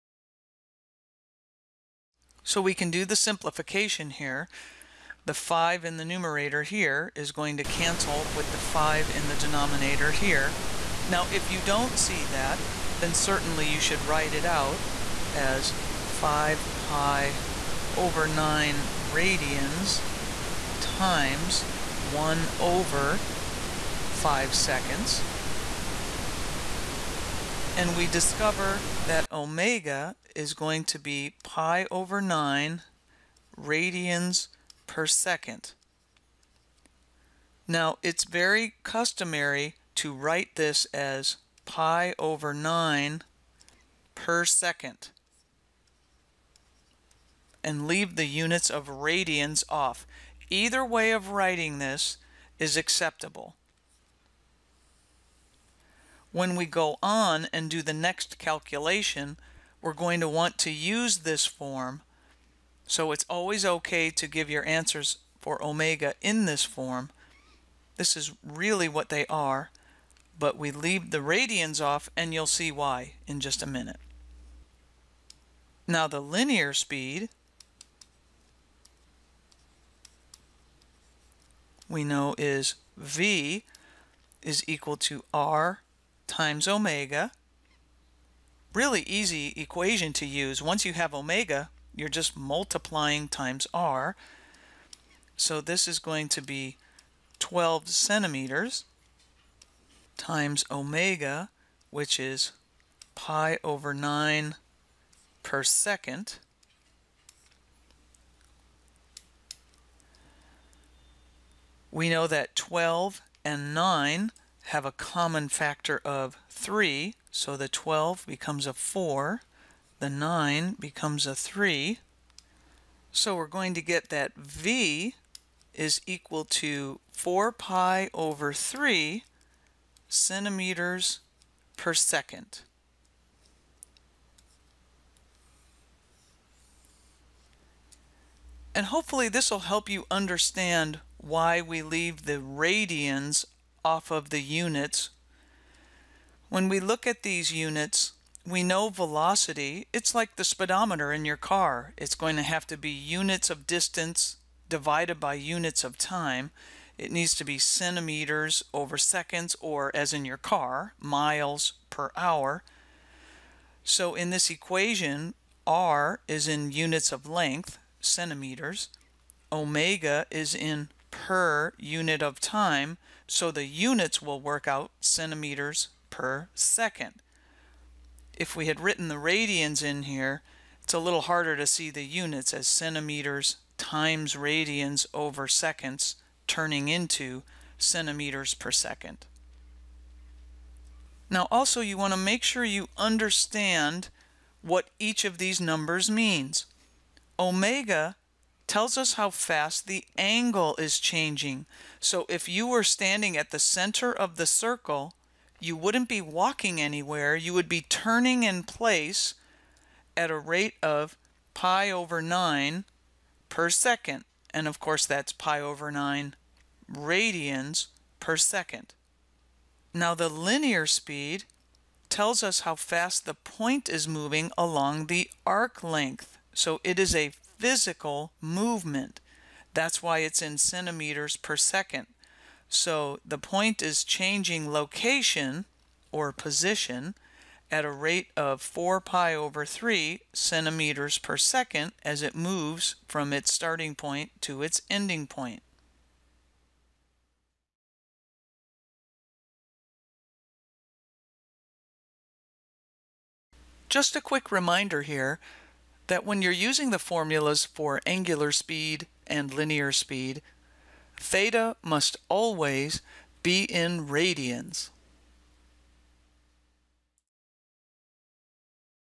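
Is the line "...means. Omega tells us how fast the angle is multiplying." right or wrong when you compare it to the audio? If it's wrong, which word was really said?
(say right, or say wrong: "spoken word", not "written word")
wrong: "changing", not "multiplying".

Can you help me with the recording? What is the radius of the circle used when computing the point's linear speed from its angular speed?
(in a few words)
12 centimeters.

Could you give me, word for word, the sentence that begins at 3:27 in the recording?
You would be turning in place at a rate of pi over 9 per second.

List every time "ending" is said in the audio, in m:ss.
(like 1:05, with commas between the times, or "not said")
4:04.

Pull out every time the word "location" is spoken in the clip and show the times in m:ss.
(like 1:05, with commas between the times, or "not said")
3:54.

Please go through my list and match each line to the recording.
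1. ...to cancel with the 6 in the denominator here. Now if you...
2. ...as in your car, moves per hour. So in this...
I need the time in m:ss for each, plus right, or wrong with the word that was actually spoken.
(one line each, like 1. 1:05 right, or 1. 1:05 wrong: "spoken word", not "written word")
1. 0:07 wrong: "5", not "6"
2. 2:39 wrong: "miles", not "moves".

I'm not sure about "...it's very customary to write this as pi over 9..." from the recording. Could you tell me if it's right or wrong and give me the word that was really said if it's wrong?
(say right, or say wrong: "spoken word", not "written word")
right.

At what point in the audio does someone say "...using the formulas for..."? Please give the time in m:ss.
4:16.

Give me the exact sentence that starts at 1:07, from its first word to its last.
This is really what they are, but we leave the radians off and you'll see why in just a minute.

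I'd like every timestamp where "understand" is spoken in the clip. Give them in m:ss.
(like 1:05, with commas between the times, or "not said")
2:20, 3:12.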